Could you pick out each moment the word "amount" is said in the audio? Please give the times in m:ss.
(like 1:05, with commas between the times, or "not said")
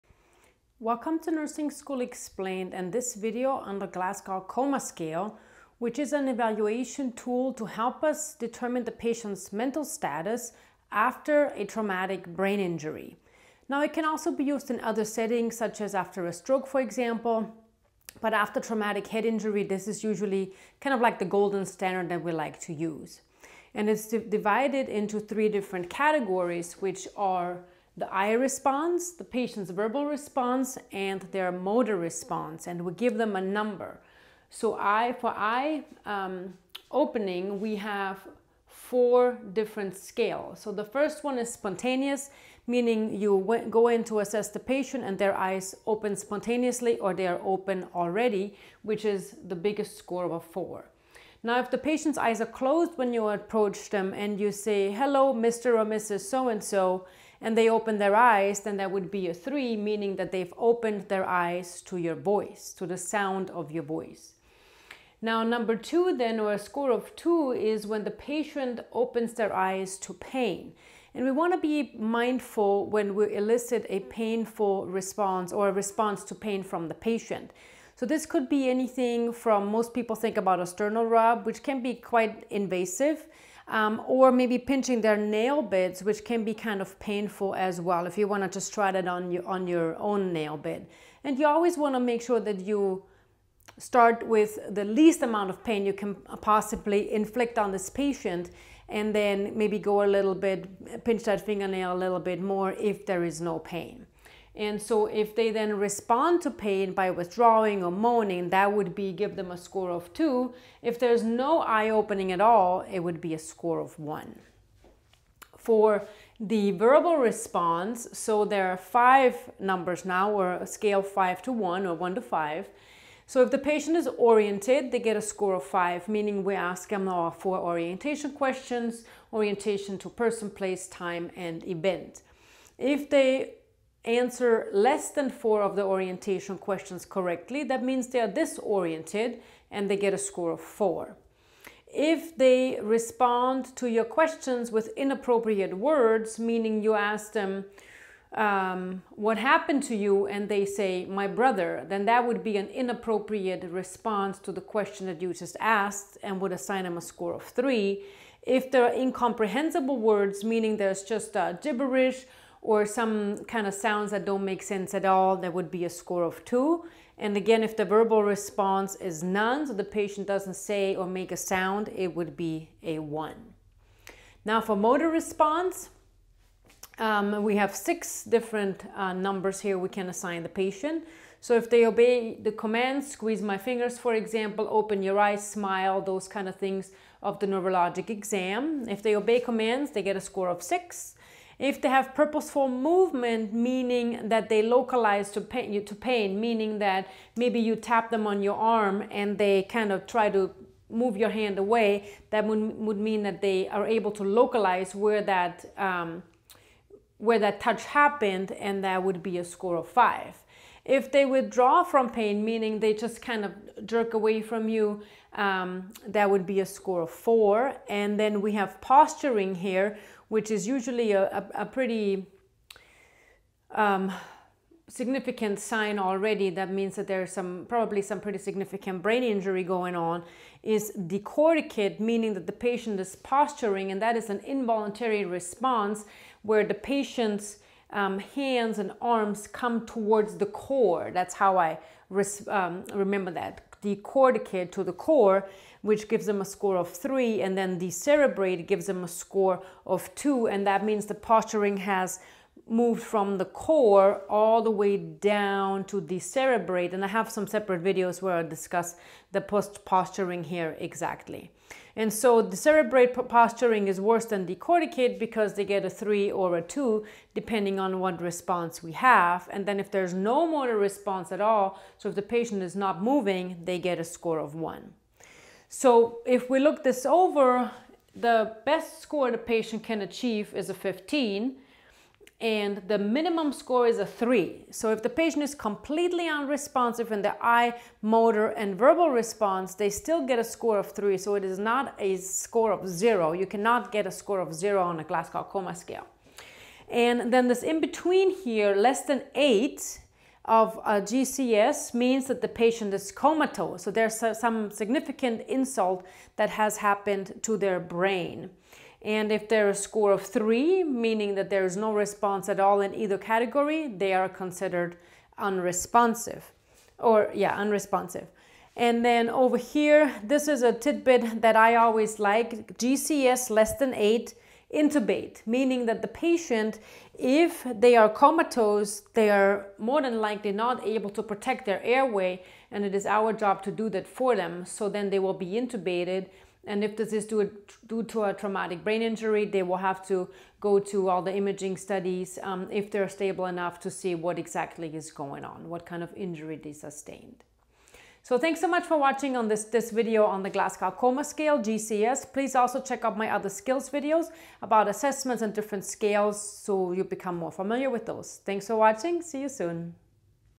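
1:35.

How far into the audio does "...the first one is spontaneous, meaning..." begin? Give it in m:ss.
0:40.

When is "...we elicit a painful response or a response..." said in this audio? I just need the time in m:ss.
1:13.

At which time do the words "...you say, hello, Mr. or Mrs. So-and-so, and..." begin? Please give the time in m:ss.
0:54.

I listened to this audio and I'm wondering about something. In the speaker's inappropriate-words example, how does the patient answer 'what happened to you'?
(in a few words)
My brother.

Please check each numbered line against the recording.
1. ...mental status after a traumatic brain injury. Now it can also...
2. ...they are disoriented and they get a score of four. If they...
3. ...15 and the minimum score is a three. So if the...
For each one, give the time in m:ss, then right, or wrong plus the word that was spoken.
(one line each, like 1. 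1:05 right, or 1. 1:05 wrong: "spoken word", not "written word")
1. 0:09 right
2. 2:18 right
3. 4:40 right.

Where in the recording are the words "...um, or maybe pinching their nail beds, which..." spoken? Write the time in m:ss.
1:23.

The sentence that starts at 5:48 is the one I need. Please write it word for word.
So thanks so much for watching on this, this video on the Glasgow Coma Scale, GCS.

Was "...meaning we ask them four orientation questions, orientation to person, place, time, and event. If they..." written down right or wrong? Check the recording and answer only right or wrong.
right.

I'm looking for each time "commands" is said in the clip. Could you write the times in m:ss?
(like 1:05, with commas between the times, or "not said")
3:02, 3:09.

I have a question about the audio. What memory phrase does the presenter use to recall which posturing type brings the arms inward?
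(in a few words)
Decorticate to the core.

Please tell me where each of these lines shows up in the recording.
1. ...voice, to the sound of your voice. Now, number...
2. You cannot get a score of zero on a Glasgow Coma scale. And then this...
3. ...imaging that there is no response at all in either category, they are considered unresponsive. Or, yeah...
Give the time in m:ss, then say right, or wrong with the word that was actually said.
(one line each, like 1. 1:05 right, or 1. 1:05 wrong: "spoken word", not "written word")
1. 1:02 right
2. 4:53 right
3. 5:10 wrong: "meaning", not "imaging".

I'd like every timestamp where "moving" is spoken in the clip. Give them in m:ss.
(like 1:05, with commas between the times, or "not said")
4:33.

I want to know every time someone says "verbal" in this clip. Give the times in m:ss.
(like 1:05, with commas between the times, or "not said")
0:29, 1:56, 2:47, 4:48.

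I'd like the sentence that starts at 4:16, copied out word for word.
And I have some separate videos where I discuss the post posturing here exactly.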